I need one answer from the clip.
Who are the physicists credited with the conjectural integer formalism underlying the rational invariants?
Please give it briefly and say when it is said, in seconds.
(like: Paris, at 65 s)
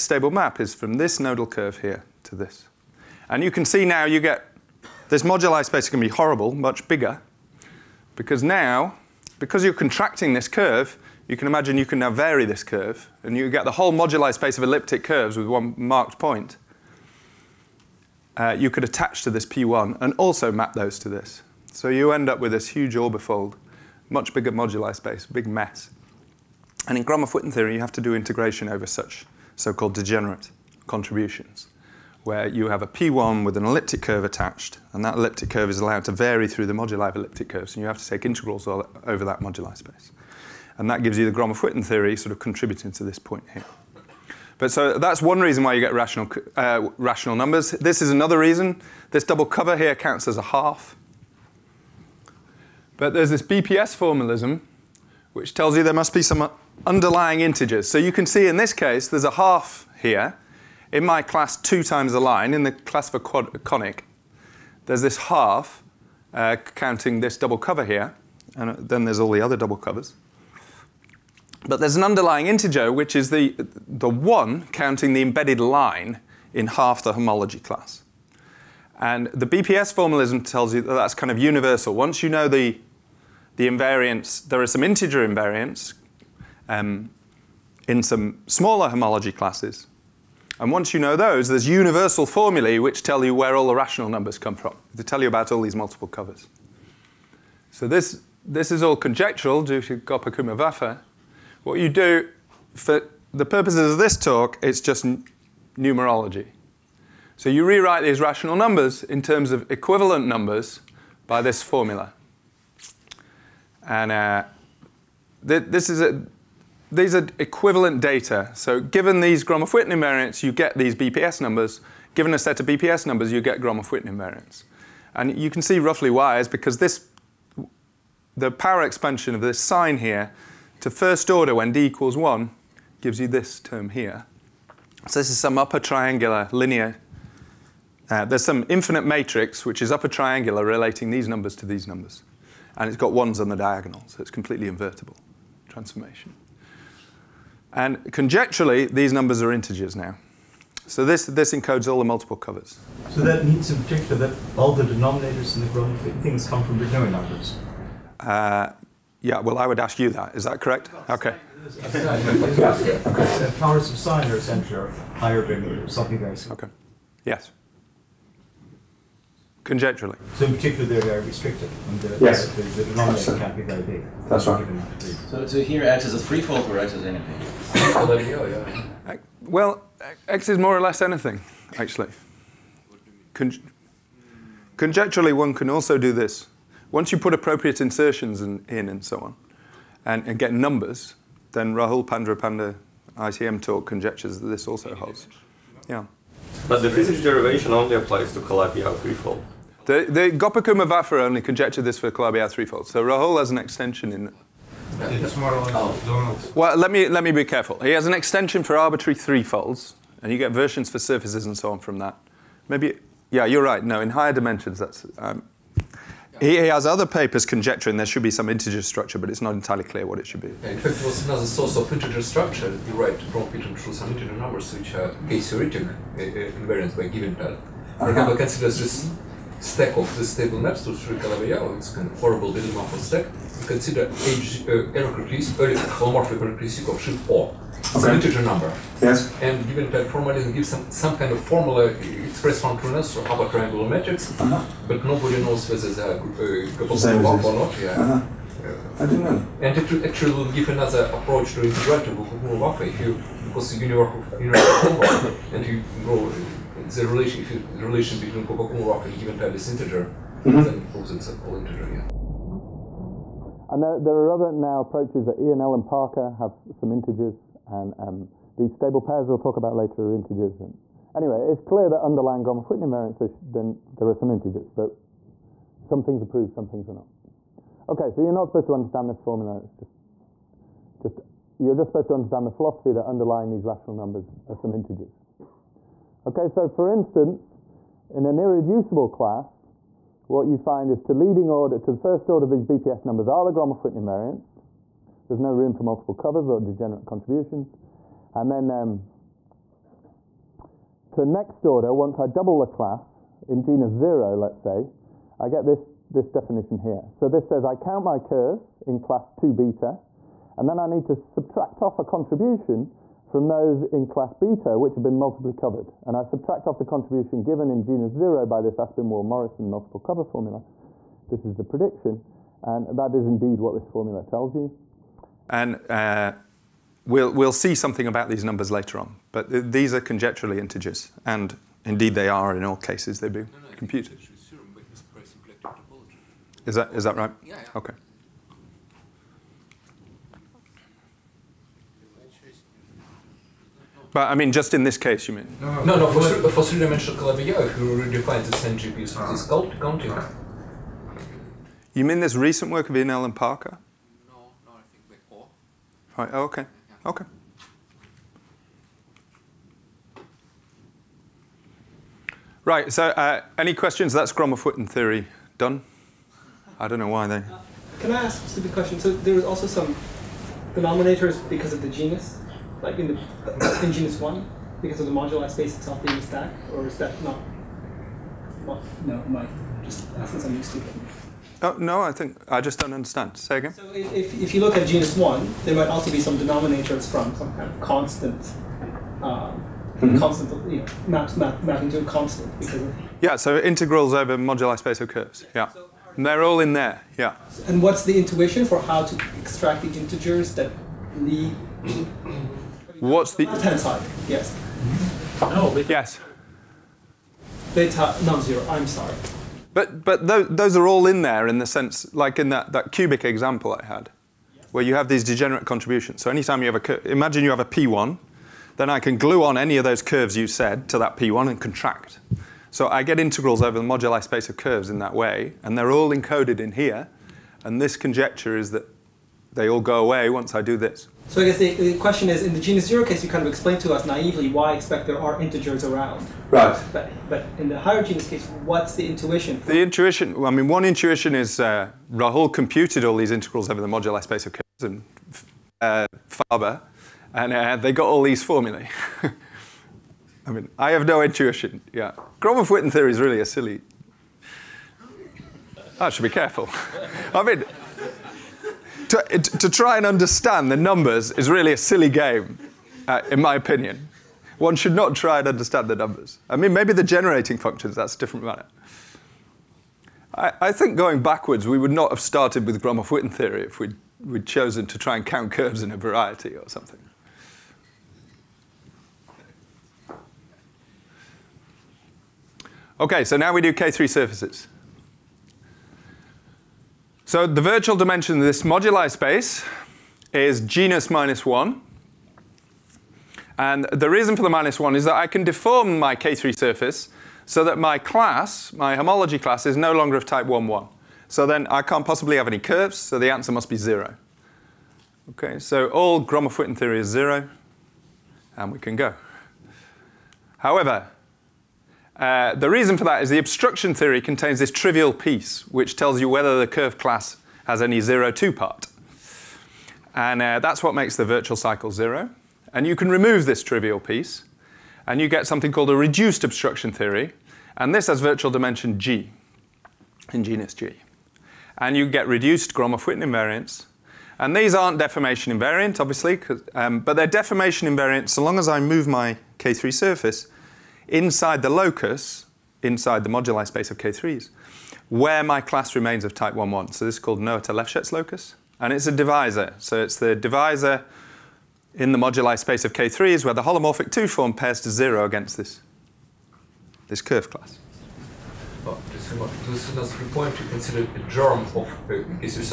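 Gopakumar-Vafa, at 99 s.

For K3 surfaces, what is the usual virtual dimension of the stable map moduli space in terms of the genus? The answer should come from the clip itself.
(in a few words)
genus minus 1.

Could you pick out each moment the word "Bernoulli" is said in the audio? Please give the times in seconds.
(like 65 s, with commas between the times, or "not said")
156 s, 165 s.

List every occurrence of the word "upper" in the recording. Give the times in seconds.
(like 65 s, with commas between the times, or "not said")
135 s, 139 s, 243 s.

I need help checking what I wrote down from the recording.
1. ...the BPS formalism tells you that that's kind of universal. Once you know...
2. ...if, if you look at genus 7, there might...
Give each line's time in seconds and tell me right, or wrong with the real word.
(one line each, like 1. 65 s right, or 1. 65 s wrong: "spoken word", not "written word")
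1. 79 s right
2. 383 s wrong: "1", not "7".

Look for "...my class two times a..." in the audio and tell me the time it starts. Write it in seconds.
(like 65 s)
61 s.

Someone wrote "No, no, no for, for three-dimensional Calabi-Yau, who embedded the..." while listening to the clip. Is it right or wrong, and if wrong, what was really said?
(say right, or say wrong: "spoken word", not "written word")
wrong: "redefined", not "embedded".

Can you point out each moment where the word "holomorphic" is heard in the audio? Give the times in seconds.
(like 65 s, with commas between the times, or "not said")
235 s, 553 s.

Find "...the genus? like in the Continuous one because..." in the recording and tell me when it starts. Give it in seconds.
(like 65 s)
371 s.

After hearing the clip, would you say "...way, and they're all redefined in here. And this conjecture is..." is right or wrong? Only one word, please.
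wrong.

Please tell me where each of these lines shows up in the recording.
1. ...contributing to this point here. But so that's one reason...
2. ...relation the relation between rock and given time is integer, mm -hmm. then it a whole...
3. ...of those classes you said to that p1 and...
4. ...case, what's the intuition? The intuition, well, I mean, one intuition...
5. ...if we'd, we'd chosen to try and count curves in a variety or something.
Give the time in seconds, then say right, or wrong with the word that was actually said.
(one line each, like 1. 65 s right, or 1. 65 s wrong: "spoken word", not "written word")
1. 42 s right
2. 257 s right
3. 419 s wrong: "curves", not "classes"
4. 438 s right
5. 473 s right.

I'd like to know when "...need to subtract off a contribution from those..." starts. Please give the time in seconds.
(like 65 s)
310 s.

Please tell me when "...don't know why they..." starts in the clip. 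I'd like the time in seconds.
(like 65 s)
366 s.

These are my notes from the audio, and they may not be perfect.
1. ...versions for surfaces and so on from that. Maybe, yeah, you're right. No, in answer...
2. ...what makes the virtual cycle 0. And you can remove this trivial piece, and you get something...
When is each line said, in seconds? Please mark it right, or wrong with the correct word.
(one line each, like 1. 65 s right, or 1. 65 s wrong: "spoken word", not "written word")
1. 210 s wrong: "higher", not "answer"
2. 520 s right.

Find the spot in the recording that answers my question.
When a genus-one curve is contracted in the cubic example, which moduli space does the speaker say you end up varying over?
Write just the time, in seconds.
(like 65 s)
13 s.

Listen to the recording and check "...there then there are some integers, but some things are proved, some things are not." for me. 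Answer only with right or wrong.
right.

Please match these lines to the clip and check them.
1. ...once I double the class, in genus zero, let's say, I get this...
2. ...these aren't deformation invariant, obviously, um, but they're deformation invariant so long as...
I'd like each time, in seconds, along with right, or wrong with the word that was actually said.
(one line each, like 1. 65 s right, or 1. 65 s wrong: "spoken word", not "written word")
1. 301 s right
2. 534 s right.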